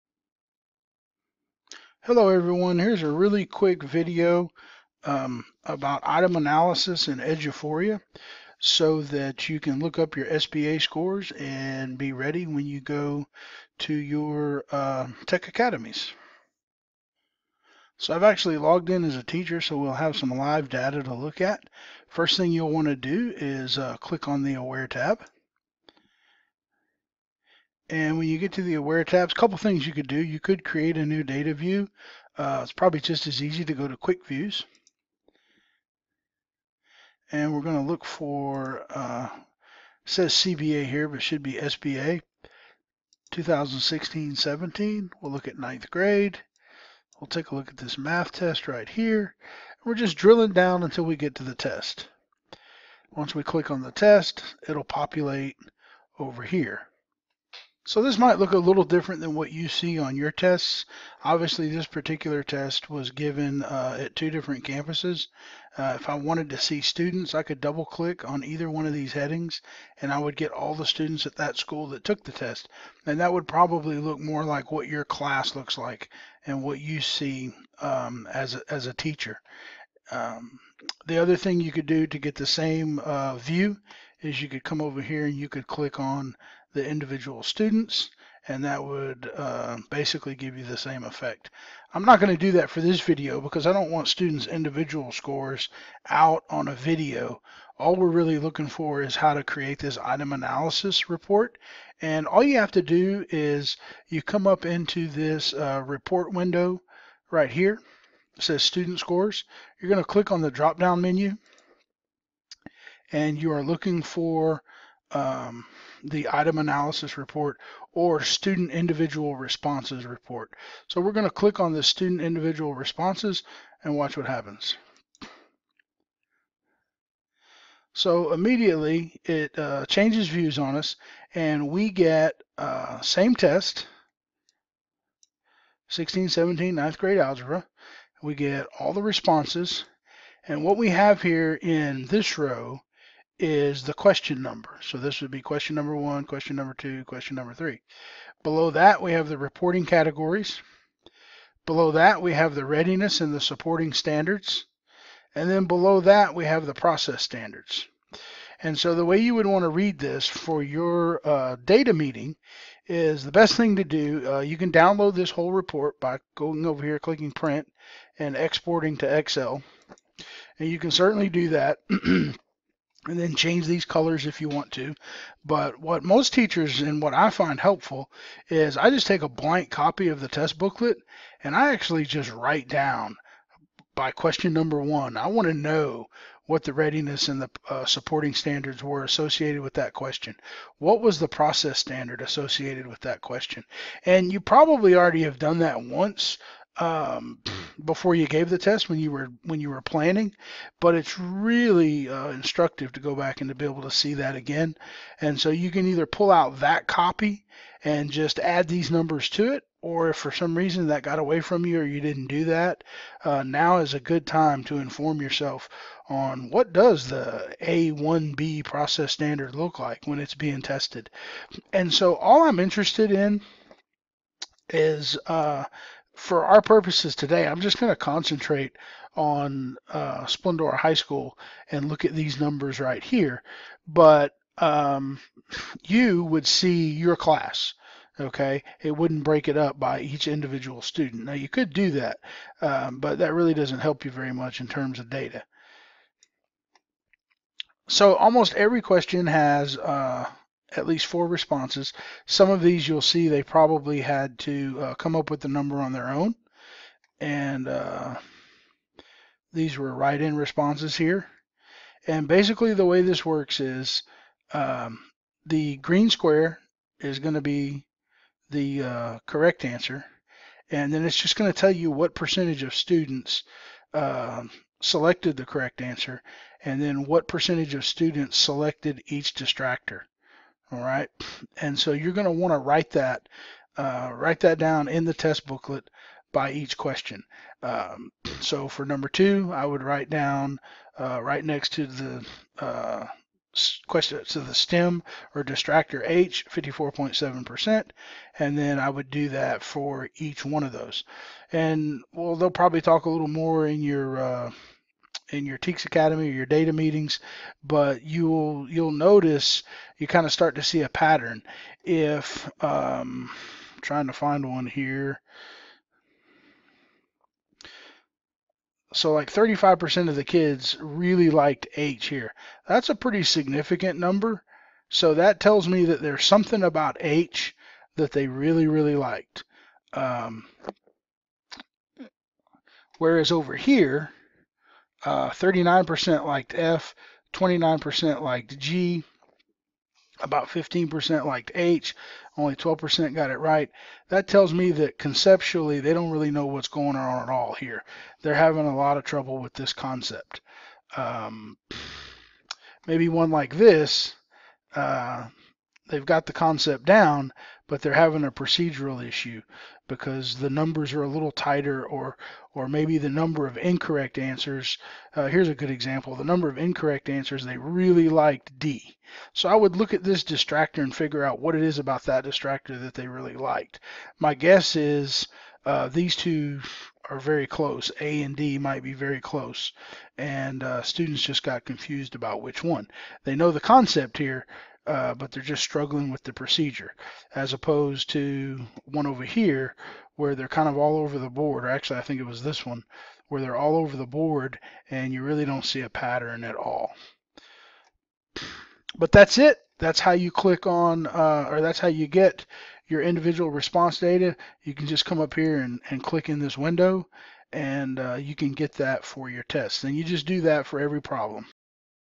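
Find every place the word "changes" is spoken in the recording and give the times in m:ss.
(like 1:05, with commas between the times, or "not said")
2:09, 2:53.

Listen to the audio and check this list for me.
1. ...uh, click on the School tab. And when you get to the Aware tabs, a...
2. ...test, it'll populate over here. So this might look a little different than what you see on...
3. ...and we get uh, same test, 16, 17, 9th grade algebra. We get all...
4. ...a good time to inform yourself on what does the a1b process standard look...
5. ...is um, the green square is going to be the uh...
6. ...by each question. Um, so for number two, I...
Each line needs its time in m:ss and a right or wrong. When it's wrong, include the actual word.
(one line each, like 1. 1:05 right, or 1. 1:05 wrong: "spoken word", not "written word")
1. 0:23 wrong: "Aware", not "School"
2. 0:53 right
3. 2:11 right
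4. 3:33 right
5. 4:23 right
6. 4:46 right.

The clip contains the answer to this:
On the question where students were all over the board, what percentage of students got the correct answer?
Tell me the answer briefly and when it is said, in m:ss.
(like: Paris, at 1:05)
12%, at 5:42.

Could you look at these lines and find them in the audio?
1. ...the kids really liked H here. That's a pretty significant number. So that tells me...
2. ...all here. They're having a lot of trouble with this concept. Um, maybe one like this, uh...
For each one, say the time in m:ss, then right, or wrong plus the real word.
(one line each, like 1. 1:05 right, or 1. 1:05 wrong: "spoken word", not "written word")
1. 5:20 right
2. 5:47 right.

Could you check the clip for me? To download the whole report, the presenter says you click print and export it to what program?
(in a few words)
Excel.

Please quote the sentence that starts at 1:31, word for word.
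I'm not going to do that for this video because I don't want students' individual scores out on a video.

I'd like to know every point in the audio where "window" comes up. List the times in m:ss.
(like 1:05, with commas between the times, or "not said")
1:46, 6:46.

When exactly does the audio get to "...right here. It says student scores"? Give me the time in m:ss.
1:47.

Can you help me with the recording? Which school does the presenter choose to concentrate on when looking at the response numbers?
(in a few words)
Splendora High School.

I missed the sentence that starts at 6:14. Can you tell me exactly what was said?
My guess is uh, these two are very close.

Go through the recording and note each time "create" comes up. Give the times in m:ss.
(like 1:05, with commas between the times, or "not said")
0:30, 1:39.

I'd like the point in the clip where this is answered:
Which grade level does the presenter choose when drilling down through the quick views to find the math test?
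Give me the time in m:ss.
0:45.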